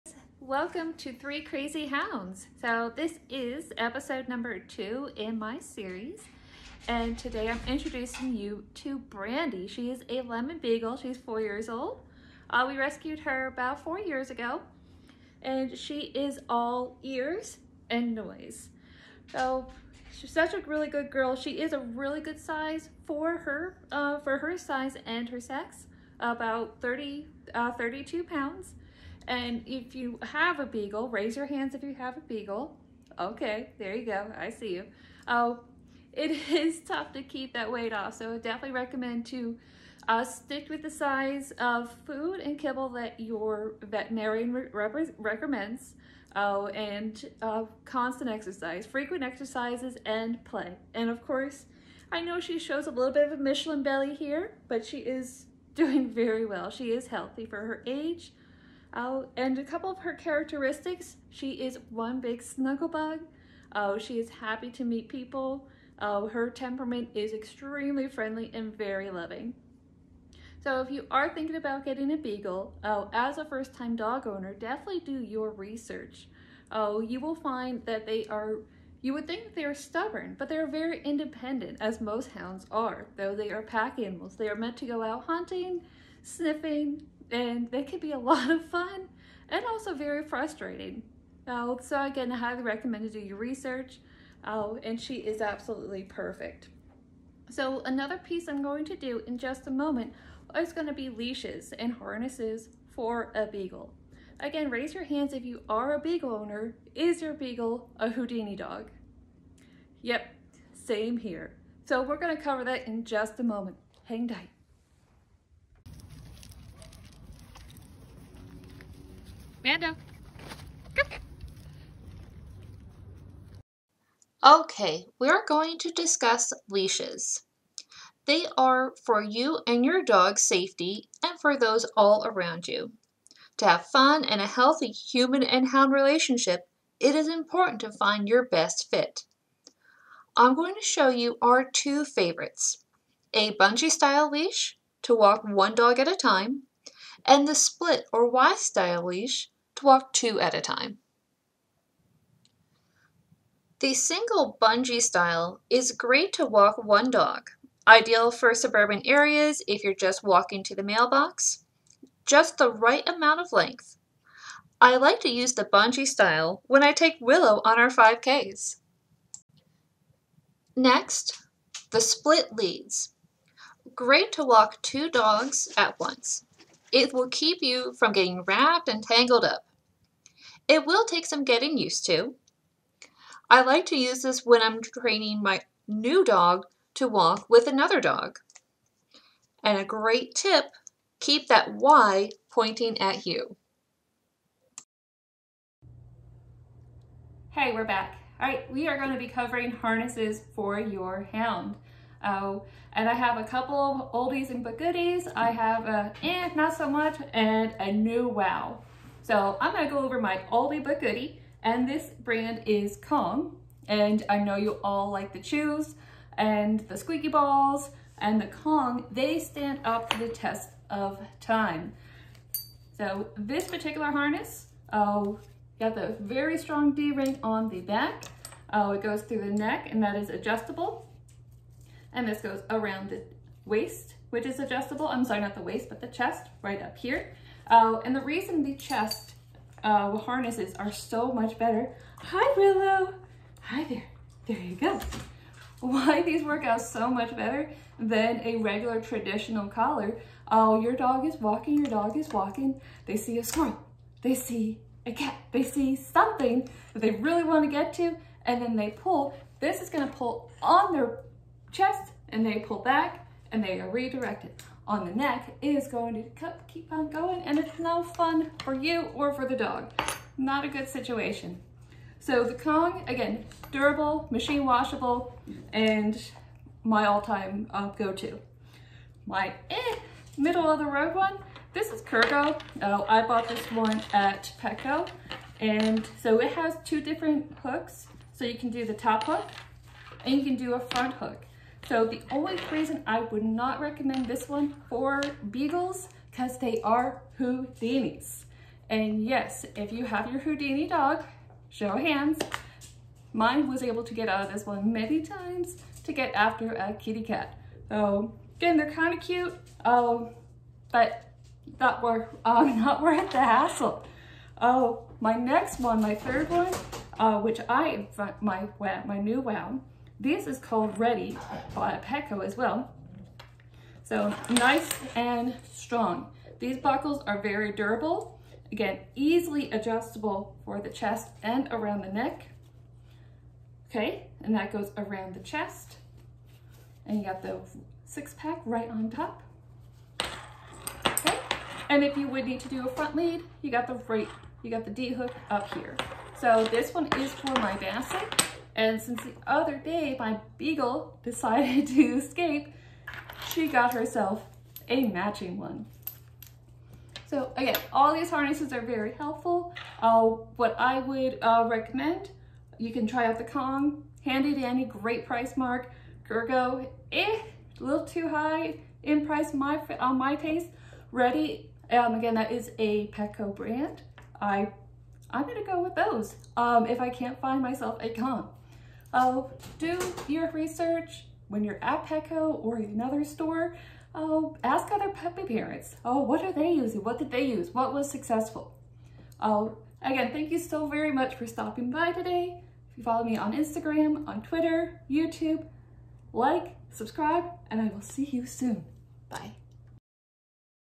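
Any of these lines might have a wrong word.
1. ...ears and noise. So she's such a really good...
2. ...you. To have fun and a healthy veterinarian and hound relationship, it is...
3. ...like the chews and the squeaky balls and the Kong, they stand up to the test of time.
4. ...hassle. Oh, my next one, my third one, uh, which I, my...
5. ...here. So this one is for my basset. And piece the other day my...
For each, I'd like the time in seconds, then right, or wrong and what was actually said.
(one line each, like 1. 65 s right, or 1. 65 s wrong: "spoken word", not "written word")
1. 17 s right
2. 132 s wrong: "human", not "veterinarian"
3. 215 s right
4. 313 s right
5. 345 s wrong: "since", not "piece".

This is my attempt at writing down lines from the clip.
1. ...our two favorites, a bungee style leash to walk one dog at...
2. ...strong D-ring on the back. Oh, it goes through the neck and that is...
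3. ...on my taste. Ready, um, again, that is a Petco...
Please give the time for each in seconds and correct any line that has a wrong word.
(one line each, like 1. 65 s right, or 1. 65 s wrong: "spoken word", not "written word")
1. 141 s right
2. 226 s right
3. 369 s right.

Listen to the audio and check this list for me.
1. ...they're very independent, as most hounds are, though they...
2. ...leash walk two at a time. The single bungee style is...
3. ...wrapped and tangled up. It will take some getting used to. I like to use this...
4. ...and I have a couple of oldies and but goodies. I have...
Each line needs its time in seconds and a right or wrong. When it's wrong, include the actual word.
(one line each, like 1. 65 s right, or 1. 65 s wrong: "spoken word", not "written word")
1. 80 s right
2. 149 s right
3. 178 s right
4. 202 s right.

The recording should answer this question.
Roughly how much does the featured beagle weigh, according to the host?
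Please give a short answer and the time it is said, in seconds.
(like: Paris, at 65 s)
32 pounds, at 27 s.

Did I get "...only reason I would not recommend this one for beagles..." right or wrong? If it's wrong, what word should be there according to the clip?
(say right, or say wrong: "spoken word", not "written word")
right.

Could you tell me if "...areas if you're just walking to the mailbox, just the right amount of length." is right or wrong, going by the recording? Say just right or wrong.
right.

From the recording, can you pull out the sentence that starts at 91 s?
Uh, so again, I highly recommend to do your research uh, and she is absolutely perfect.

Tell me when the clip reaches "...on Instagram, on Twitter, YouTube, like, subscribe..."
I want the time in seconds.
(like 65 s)
393 s.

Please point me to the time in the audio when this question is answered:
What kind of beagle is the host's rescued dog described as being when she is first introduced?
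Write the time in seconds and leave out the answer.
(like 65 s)
10 s.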